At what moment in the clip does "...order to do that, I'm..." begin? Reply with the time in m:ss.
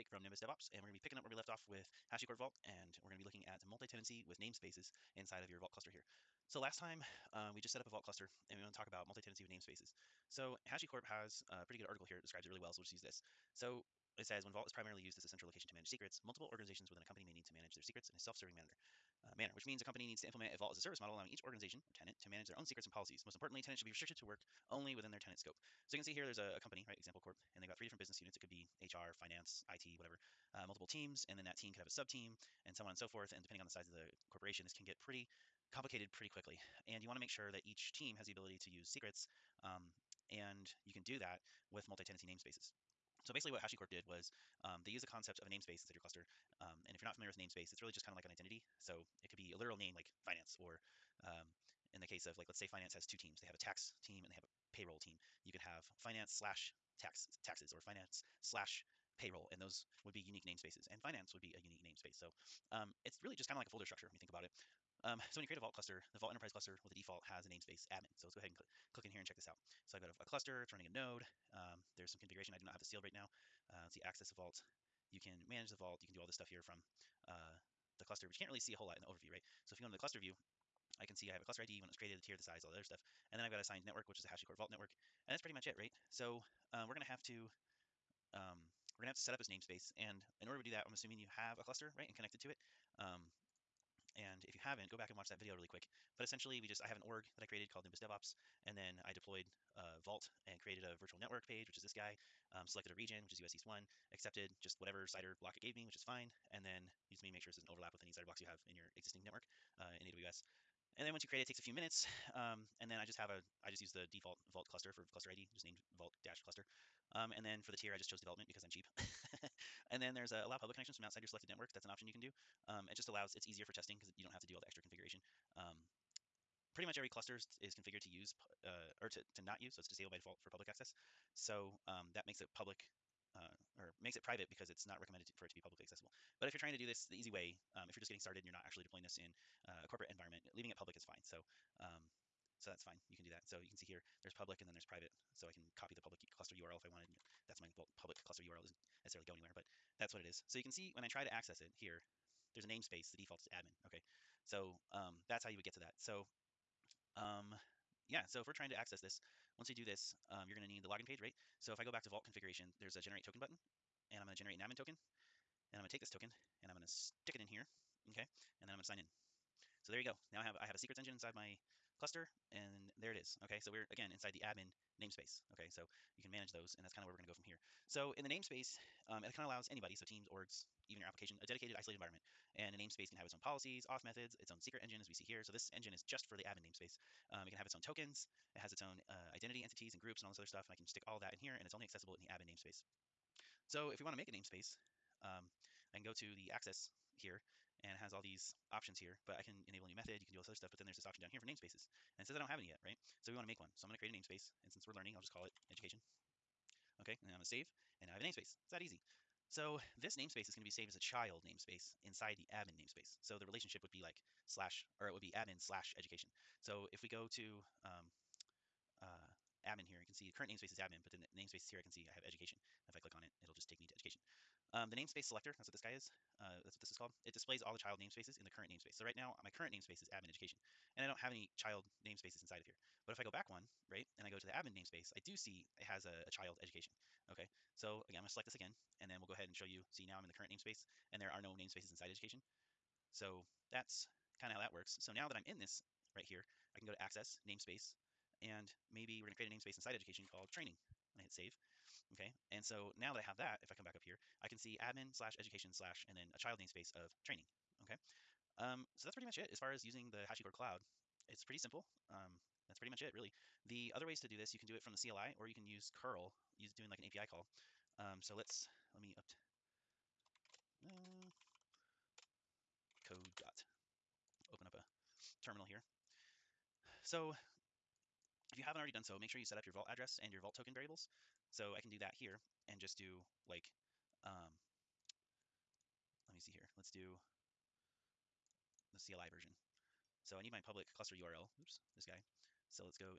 1:30.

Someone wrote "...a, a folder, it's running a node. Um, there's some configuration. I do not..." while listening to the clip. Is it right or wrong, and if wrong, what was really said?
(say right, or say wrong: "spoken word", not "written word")
wrong: "cluster", not "folder".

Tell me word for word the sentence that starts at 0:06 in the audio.
So last time um, we just set up a Vault cluster, and we want to talk about multi-tenancy with namespaces.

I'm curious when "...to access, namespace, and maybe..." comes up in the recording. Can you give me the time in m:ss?
4:06.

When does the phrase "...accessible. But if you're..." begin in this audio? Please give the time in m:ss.
2:15.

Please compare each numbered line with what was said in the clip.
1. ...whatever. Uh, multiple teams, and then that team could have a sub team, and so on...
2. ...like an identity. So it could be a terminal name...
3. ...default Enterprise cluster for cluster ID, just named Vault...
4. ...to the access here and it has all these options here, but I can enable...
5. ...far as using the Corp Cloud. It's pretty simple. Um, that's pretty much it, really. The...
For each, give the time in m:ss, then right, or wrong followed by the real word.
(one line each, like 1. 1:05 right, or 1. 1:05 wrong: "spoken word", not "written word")
1. 0:29 right
2. 0:48 wrong: "literal", not "terminal"
3. 1:54 wrong: "Vault", not "Enterprise"
4. 3:16 right
5. 4:19 wrong: "HashiCorp", not "Corp".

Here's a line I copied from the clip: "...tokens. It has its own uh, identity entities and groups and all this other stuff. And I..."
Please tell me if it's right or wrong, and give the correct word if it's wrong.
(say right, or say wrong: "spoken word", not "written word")
right.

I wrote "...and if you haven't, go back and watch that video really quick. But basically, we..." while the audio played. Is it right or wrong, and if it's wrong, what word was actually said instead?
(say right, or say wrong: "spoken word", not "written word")
wrong: "essentially", not "basically".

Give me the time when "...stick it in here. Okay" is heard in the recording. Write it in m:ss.
2:46.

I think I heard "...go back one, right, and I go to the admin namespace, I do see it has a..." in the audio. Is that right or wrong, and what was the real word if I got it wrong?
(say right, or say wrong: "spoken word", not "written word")
right.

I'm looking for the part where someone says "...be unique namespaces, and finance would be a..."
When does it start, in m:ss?
1:00.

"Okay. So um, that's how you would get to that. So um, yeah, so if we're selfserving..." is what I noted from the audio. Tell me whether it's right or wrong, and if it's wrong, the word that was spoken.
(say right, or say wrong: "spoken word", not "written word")
wrong: "trying", not "selfserving".